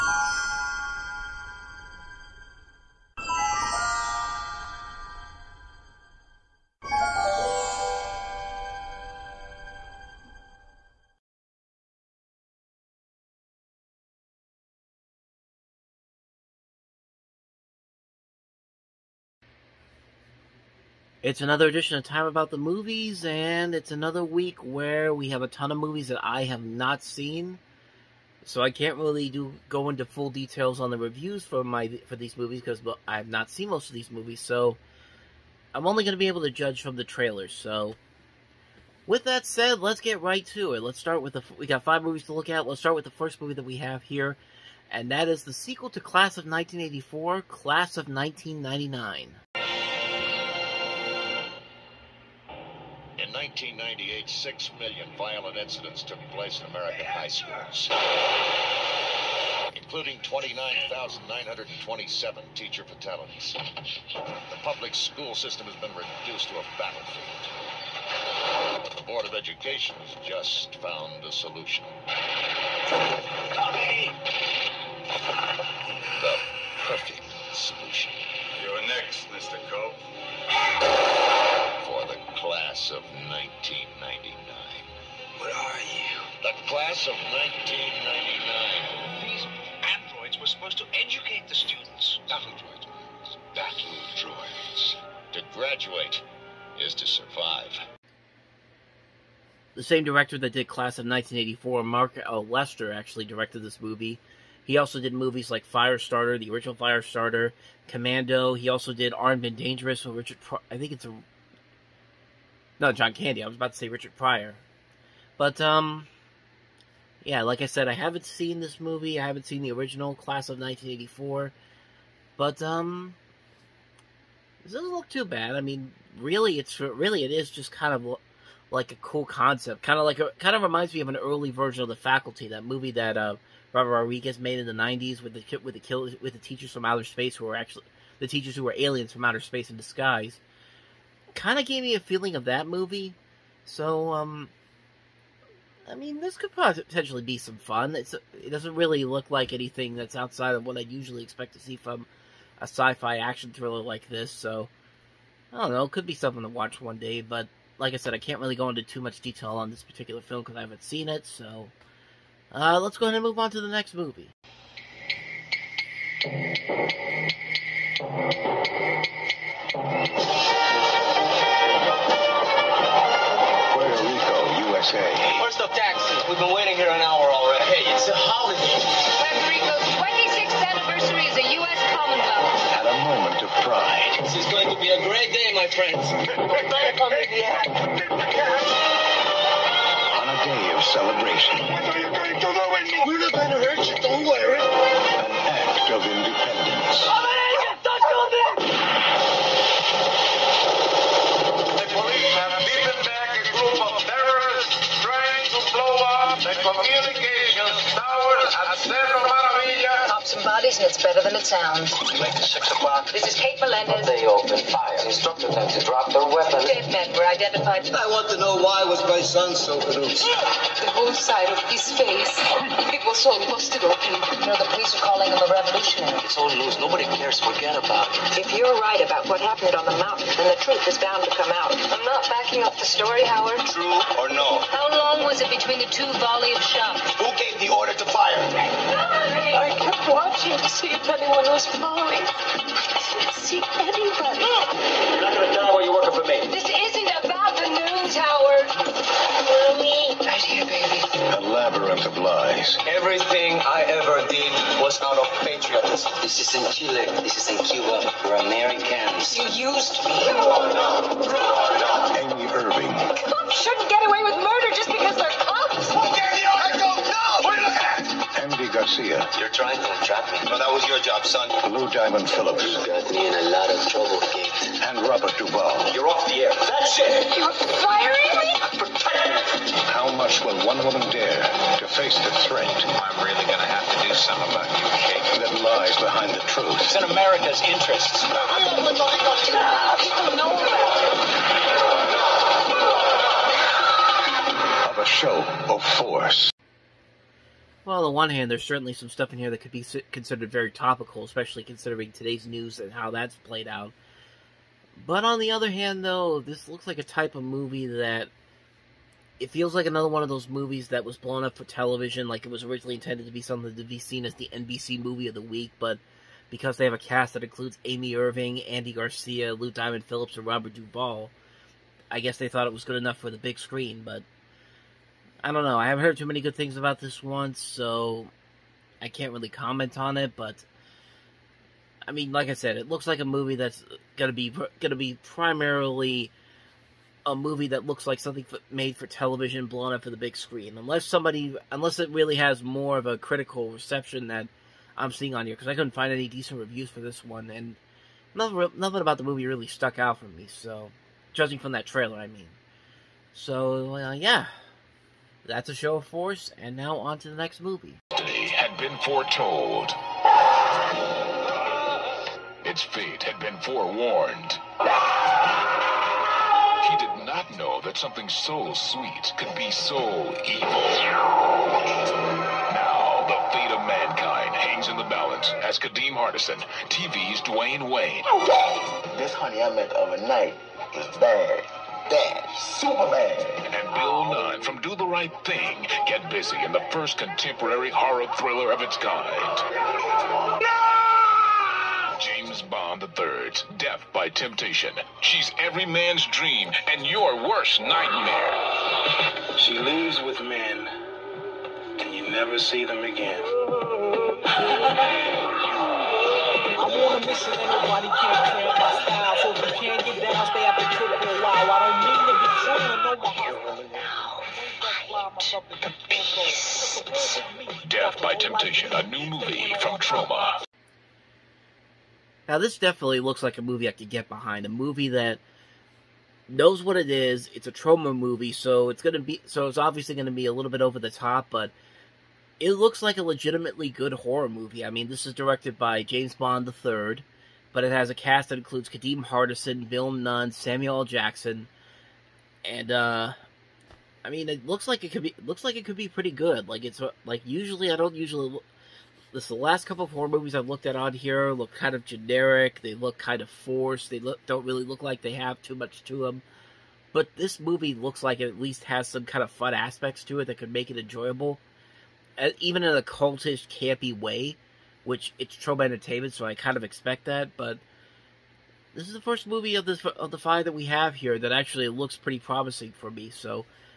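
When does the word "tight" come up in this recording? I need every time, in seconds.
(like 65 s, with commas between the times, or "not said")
not said.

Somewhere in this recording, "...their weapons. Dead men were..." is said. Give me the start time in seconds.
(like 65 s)
216 s.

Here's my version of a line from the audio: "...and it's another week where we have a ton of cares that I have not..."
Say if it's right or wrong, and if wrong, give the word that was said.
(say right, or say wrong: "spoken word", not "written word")
wrong: "movies", not "cares".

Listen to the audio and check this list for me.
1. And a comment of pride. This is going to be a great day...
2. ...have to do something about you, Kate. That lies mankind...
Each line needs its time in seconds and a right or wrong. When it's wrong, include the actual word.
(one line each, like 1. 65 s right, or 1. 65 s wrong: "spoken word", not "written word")
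1. 182 s wrong: "moment", not "comment"
2. 283 s wrong: "behind", not "mankind".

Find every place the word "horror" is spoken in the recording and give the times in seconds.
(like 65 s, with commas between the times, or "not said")
387 s, 434 s, 450 s.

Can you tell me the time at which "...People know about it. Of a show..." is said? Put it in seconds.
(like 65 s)
290 s.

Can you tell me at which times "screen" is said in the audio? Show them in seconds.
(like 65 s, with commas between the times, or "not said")
323 s, 340 s.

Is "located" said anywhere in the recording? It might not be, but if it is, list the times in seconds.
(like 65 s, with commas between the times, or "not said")
not said.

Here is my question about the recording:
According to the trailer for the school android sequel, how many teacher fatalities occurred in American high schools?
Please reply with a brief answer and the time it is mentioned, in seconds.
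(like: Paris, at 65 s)
29,927, at 60 s.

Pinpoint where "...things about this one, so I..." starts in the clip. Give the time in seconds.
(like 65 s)
326 s.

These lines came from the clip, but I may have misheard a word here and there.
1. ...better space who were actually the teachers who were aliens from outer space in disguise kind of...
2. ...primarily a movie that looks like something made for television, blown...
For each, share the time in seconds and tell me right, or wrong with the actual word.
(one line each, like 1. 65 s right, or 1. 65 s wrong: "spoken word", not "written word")
1. 136 s wrong: "outer", not "better"
2. 335 s right.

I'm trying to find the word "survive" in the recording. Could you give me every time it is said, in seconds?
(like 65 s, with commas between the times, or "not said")
97 s.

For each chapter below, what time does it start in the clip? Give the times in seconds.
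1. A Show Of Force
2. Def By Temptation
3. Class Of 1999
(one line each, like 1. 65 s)
1. 162 s
2. 356 s
3. 48 s.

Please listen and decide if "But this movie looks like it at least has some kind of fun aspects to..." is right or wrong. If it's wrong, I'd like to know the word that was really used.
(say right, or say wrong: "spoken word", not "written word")
right.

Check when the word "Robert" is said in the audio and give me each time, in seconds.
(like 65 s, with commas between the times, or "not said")
133 s, 275 s, 320 s.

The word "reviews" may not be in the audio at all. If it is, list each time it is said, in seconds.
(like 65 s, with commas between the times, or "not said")
30 s, 346 s.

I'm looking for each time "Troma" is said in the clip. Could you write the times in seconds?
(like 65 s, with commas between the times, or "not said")
419 s, 427 s, 465 s.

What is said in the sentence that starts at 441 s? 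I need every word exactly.
Jackson, and uh, I mean, it looks like it could be looks like it could be pretty good.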